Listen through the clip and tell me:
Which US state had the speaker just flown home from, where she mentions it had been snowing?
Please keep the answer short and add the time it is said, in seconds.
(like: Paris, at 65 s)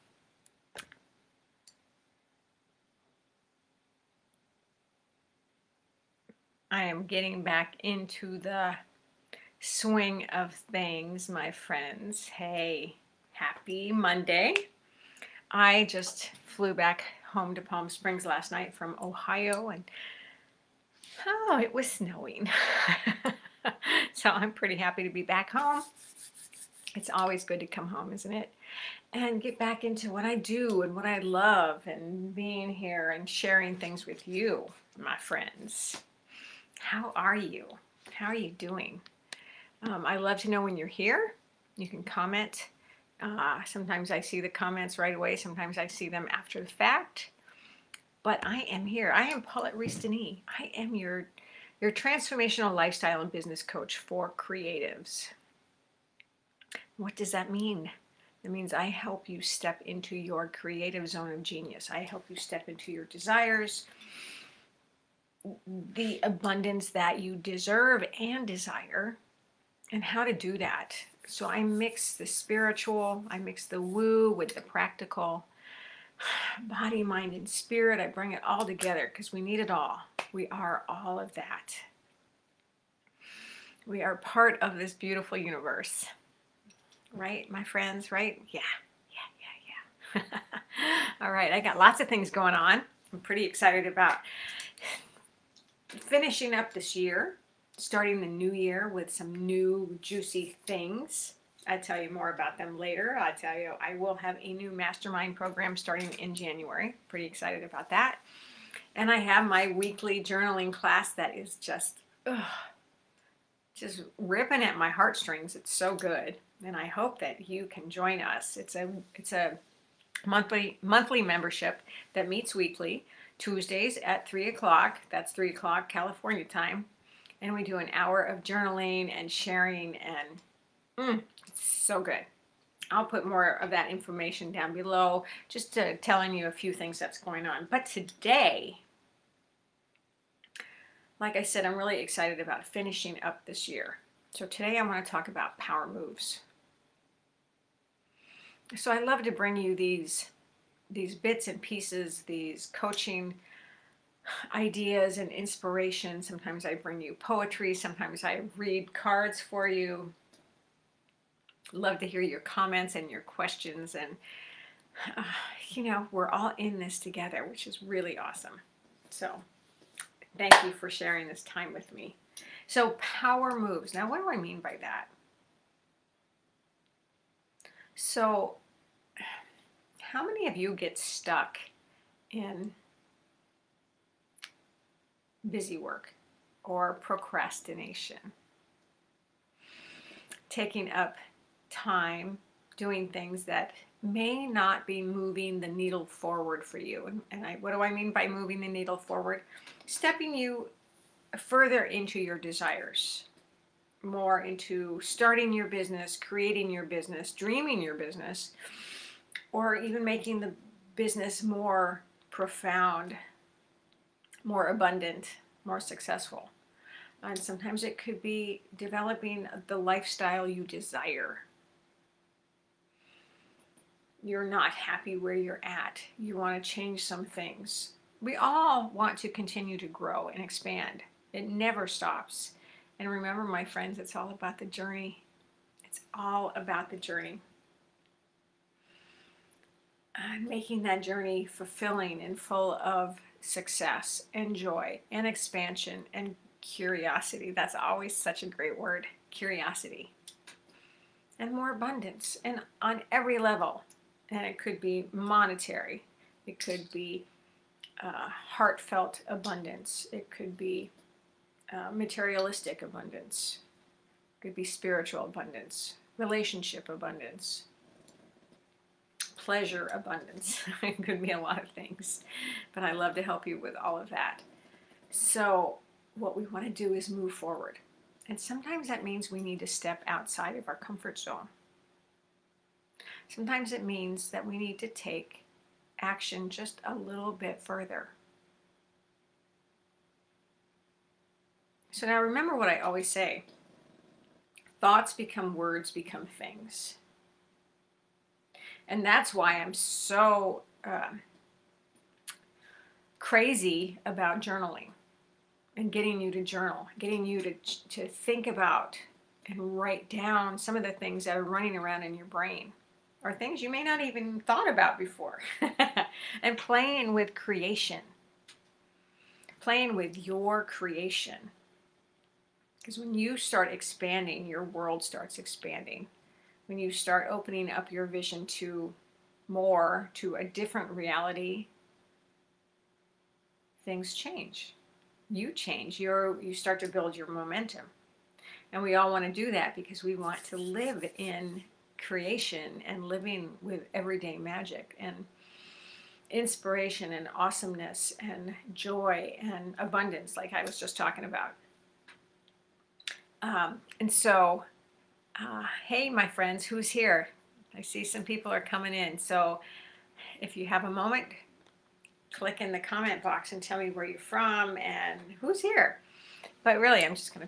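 Ohio, at 19 s.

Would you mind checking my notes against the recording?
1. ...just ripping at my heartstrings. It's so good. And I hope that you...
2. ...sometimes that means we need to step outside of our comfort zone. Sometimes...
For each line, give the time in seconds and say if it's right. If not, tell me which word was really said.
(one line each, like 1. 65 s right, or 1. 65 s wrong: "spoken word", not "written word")
1. 113 s right
2. 278 s right.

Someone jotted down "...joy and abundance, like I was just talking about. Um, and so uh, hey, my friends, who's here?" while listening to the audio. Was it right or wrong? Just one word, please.
right.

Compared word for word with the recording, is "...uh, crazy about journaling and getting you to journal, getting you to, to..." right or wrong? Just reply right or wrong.
right.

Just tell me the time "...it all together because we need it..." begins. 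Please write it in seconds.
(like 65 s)
78 s.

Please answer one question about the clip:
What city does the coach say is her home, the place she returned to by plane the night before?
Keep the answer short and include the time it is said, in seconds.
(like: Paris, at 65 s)
Palm Springs, at 17 s.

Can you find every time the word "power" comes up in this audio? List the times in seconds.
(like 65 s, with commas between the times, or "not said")
145 s, 173 s.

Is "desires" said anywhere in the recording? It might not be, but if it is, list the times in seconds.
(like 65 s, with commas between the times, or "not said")
63 s, 68 s, 202 s, 220 s.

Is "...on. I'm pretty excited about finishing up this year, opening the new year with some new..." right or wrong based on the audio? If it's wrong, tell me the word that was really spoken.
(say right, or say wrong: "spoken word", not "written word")
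wrong: "starting", not "opening".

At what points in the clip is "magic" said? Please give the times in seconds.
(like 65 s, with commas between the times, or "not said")
344 s.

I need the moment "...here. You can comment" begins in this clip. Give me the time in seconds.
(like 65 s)
40 s.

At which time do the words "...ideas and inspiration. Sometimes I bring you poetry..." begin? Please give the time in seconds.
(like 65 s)
154 s.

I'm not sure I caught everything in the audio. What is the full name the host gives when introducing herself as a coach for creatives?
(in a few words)
Paulette Rees-Denis.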